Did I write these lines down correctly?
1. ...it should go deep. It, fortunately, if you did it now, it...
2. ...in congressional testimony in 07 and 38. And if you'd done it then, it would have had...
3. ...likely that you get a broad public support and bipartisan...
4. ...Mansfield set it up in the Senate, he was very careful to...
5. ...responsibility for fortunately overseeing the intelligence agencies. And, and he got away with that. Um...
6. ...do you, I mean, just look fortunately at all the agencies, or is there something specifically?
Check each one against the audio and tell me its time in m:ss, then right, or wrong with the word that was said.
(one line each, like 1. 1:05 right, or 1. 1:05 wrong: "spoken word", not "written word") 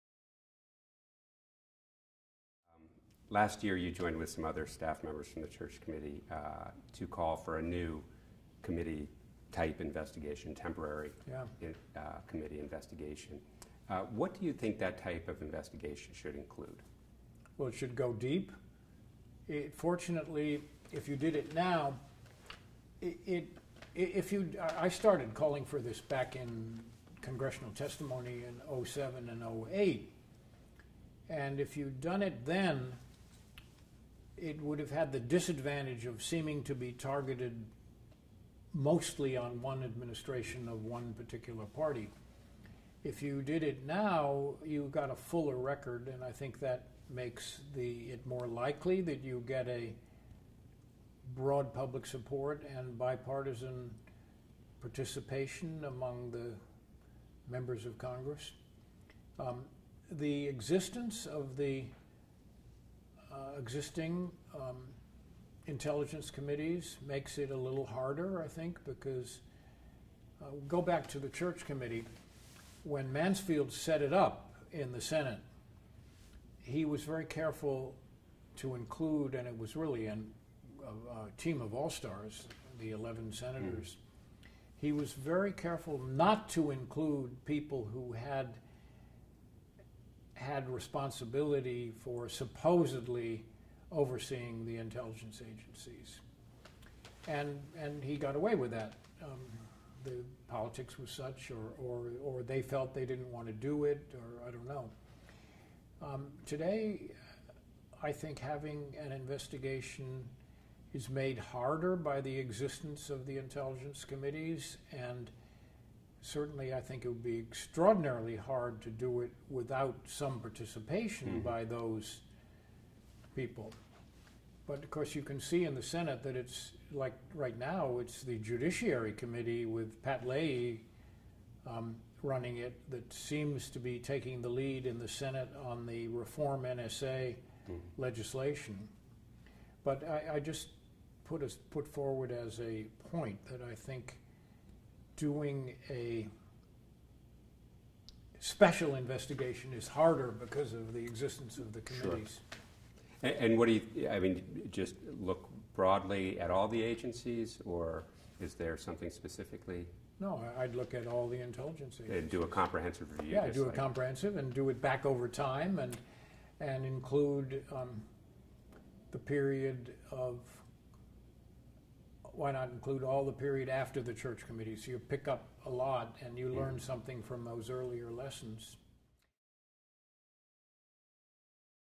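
1. 0:17 right
2. 0:26 wrong: "08", not "38"
3. 0:48 right
4. 1:13 right
5. 1:30 wrong: "supposedly", not "fortunately"
6. 2:33 wrong: "broadly", not "fortunately".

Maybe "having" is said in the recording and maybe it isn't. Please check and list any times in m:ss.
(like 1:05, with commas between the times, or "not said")
1:48.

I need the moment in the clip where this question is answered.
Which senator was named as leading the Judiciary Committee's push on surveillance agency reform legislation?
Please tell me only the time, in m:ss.
2:10.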